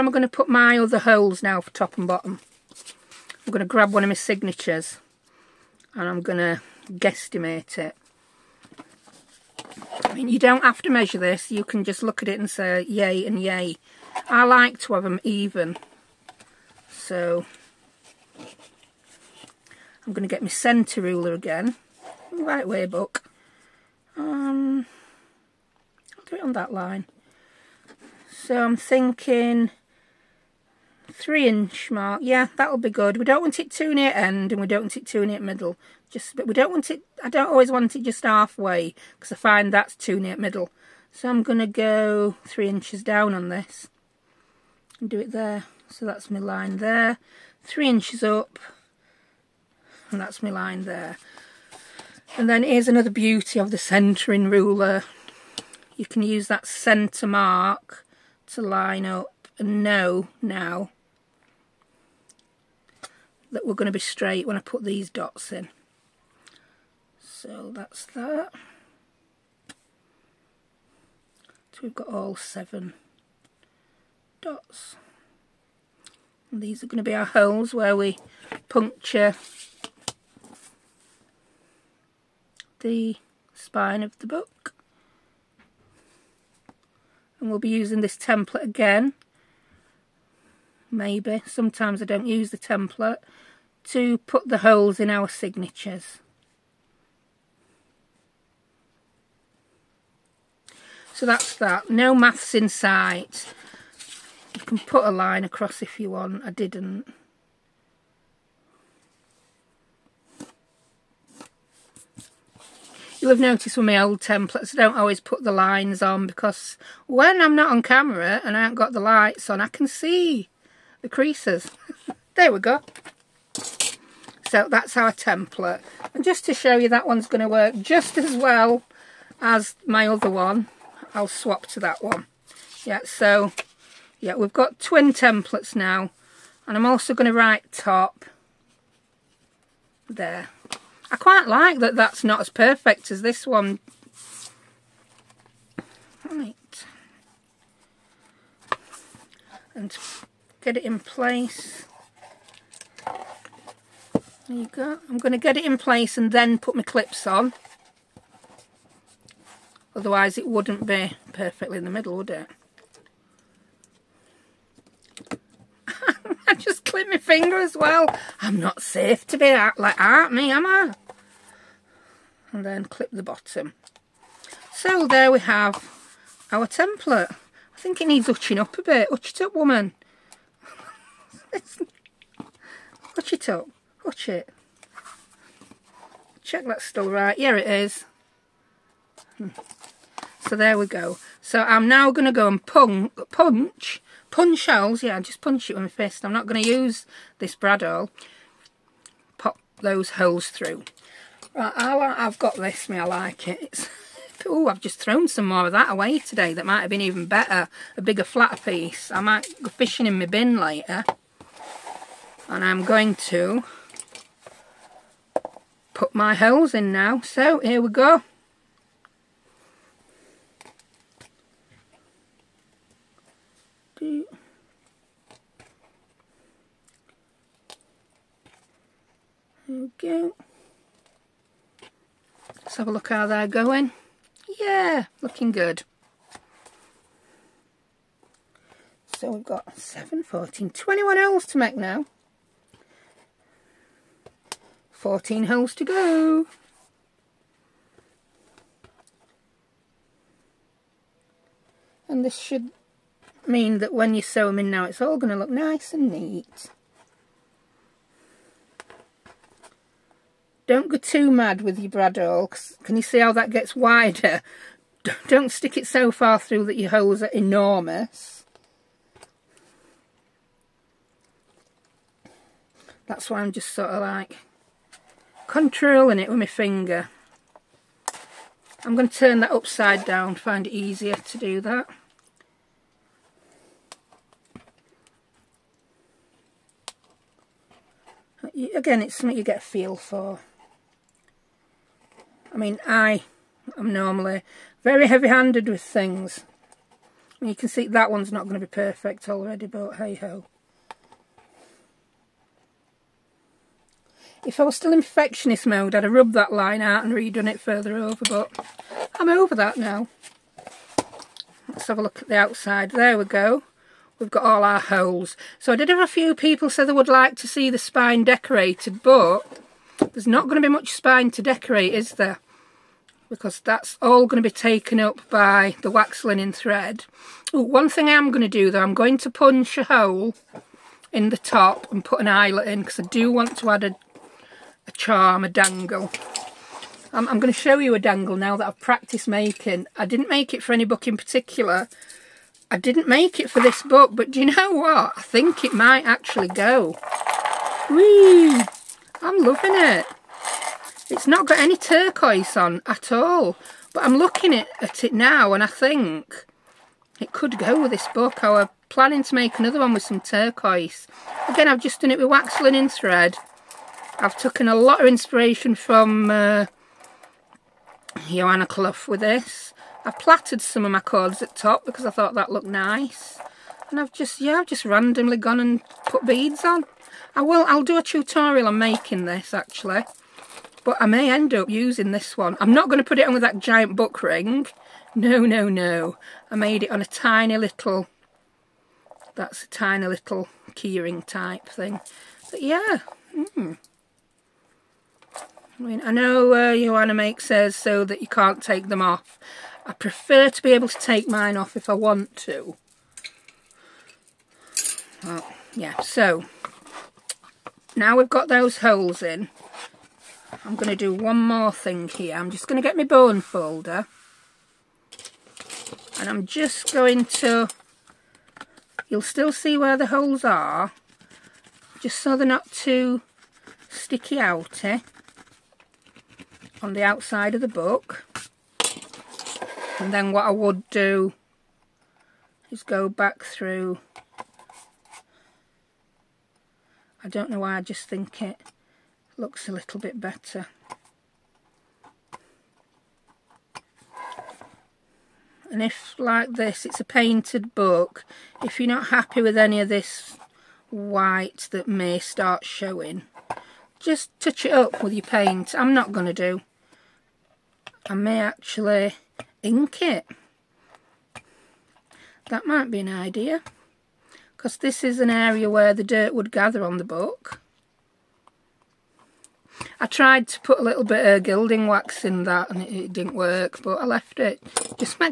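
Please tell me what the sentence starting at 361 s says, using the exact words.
Again, I've just done it with wax linen thread.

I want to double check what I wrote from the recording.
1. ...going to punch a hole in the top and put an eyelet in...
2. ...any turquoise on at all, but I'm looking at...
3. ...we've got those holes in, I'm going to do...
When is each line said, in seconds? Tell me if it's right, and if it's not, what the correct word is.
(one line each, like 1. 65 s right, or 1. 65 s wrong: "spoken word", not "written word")
1. 328 s right
2. 351 s right
3. 408 s right.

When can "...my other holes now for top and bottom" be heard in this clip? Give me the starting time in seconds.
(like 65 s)
0 s.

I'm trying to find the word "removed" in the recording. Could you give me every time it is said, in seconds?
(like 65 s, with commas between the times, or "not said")
not said.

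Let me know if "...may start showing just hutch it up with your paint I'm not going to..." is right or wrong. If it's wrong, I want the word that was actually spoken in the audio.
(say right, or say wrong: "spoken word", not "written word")
wrong: "touch", not "hutch".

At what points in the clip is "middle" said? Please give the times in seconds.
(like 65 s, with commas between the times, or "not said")
35 s, 40 s, 161 s.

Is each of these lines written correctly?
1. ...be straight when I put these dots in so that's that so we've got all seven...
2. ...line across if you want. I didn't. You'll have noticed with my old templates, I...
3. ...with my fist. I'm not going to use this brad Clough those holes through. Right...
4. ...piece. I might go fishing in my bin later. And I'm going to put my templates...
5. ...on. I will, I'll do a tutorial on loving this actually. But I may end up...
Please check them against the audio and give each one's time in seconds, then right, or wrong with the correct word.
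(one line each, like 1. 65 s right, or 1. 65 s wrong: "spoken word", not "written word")
1. 63 s right
2. 105 s right
3. 195 s wrong: "Pop", not "Clough"
4. 208 s wrong: "holes", not "templates"
5. 376 s wrong: "making", not "loving".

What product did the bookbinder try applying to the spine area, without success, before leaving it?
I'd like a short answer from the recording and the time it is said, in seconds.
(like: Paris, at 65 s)
gilding wax, at 471 s.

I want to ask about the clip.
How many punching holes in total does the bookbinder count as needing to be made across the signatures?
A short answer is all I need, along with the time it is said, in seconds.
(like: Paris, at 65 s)
21, at 240 s.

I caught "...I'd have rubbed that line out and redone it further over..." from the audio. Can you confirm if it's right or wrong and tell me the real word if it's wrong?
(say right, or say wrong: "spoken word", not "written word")
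right.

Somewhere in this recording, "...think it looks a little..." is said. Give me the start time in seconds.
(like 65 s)
438 s.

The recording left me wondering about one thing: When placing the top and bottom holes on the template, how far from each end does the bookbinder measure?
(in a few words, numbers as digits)
3 inches.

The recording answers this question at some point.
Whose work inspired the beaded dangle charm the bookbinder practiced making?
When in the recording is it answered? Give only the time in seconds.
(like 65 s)
368 s.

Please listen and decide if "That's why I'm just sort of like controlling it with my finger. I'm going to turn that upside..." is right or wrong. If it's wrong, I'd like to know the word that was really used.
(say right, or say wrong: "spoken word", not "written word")
right.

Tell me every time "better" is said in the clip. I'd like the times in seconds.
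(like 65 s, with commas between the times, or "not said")
207 s, 440 s.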